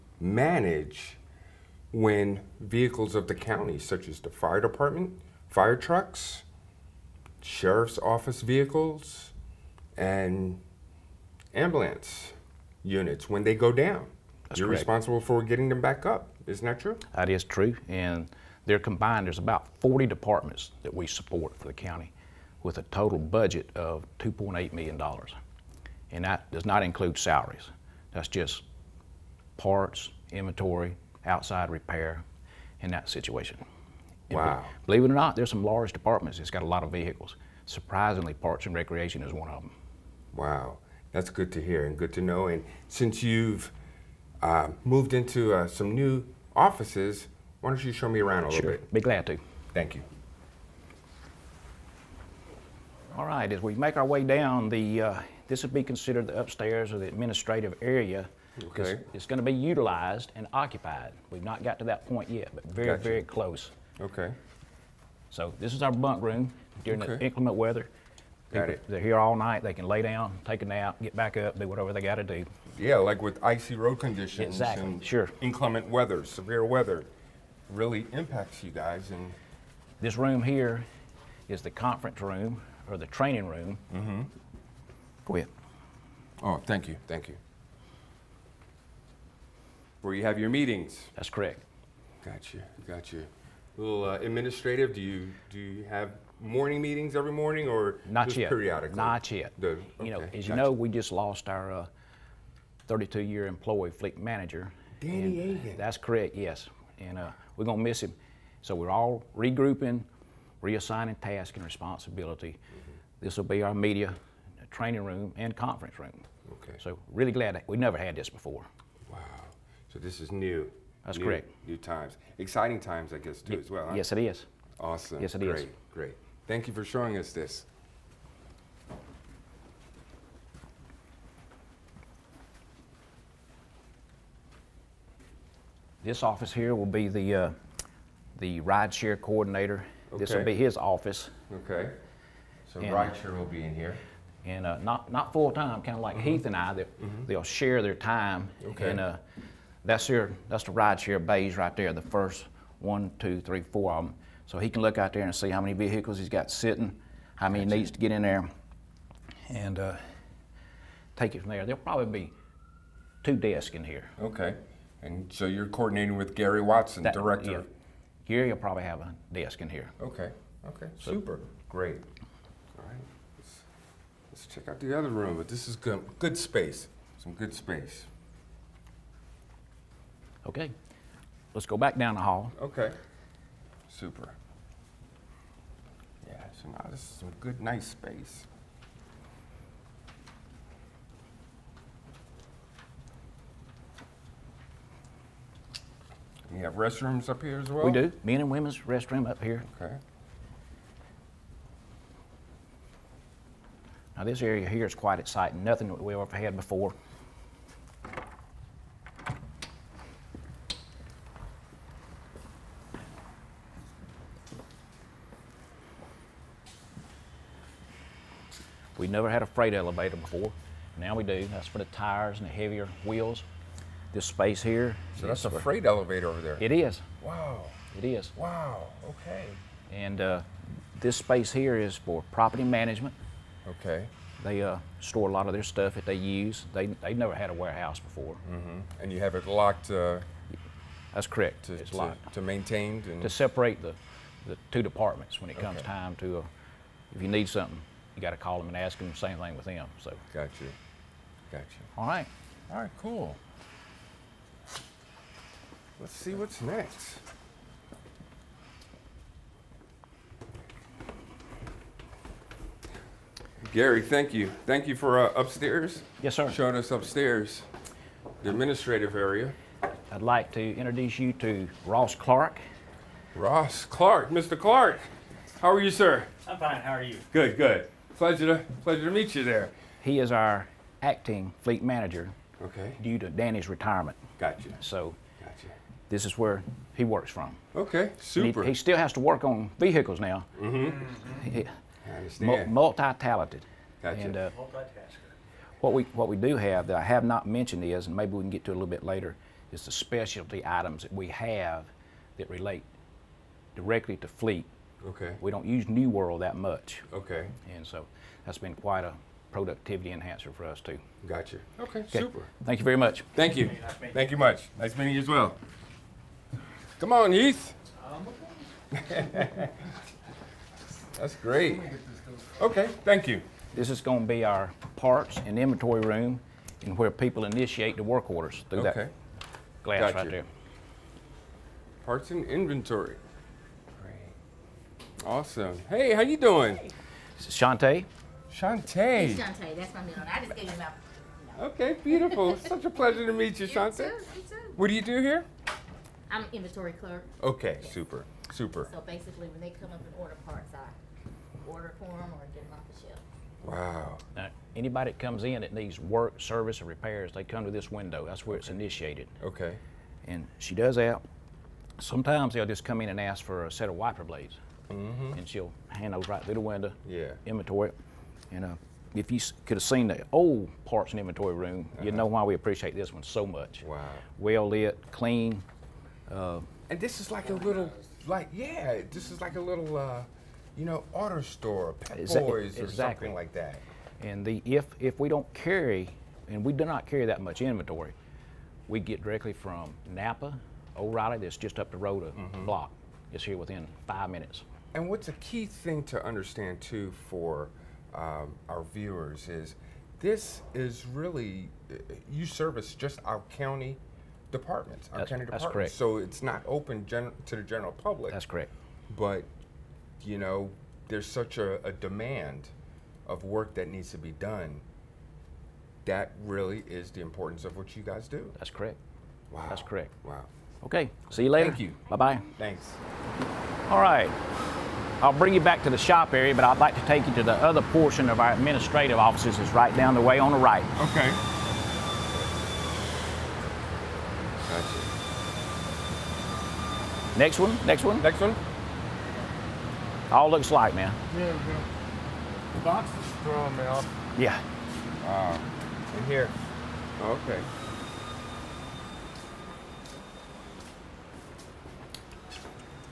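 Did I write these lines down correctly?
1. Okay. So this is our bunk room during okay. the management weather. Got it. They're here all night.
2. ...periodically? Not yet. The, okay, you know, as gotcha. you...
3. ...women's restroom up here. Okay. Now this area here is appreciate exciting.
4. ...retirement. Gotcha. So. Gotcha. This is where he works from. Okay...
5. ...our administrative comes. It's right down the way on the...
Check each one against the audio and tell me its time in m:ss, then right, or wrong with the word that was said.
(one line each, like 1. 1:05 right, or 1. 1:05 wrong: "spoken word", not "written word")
1. 1:04 wrong: "inclement", not "management"
2. 1:38 right
3. 3:18 wrong: "quite", not "appreciate"
4. 4:43 right
5. 7:08 wrong: "offices", not "comes".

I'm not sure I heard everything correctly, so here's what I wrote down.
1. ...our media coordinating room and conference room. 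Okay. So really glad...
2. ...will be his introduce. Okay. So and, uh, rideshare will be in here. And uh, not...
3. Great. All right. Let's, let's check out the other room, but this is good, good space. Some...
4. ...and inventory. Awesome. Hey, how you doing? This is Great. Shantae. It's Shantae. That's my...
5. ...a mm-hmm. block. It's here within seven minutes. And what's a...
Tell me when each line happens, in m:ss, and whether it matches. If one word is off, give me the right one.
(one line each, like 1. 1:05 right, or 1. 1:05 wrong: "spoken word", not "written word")
1. 1:53 wrong: "training", not "coordinating"
2. 2:20 wrong: "office", not "introduce"
3. 2:51 right
4. 5:32 wrong: "Shantae", not "Great"
5. 6:32 wrong: "five", not "seven".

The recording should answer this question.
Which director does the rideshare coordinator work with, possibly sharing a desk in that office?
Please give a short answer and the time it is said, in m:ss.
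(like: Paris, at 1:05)
Gary Watson, at 2:46.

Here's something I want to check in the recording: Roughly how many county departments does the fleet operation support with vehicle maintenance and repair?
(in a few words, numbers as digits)
40.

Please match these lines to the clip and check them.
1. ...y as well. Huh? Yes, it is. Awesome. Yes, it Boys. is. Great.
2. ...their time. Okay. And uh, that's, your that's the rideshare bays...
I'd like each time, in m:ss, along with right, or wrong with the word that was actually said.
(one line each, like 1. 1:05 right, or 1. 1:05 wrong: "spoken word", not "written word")
1. 2:03 wrong: "Great", not "Boys"
2. 2:27 right.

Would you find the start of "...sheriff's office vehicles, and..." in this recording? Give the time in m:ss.
0:07.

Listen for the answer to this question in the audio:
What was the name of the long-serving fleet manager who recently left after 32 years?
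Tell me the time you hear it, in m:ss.
1:44.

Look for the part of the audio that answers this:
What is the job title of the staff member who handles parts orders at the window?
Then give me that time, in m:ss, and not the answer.
5:46.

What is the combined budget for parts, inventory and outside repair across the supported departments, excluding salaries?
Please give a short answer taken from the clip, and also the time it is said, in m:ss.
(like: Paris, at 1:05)
$2.8 million, at 0:24.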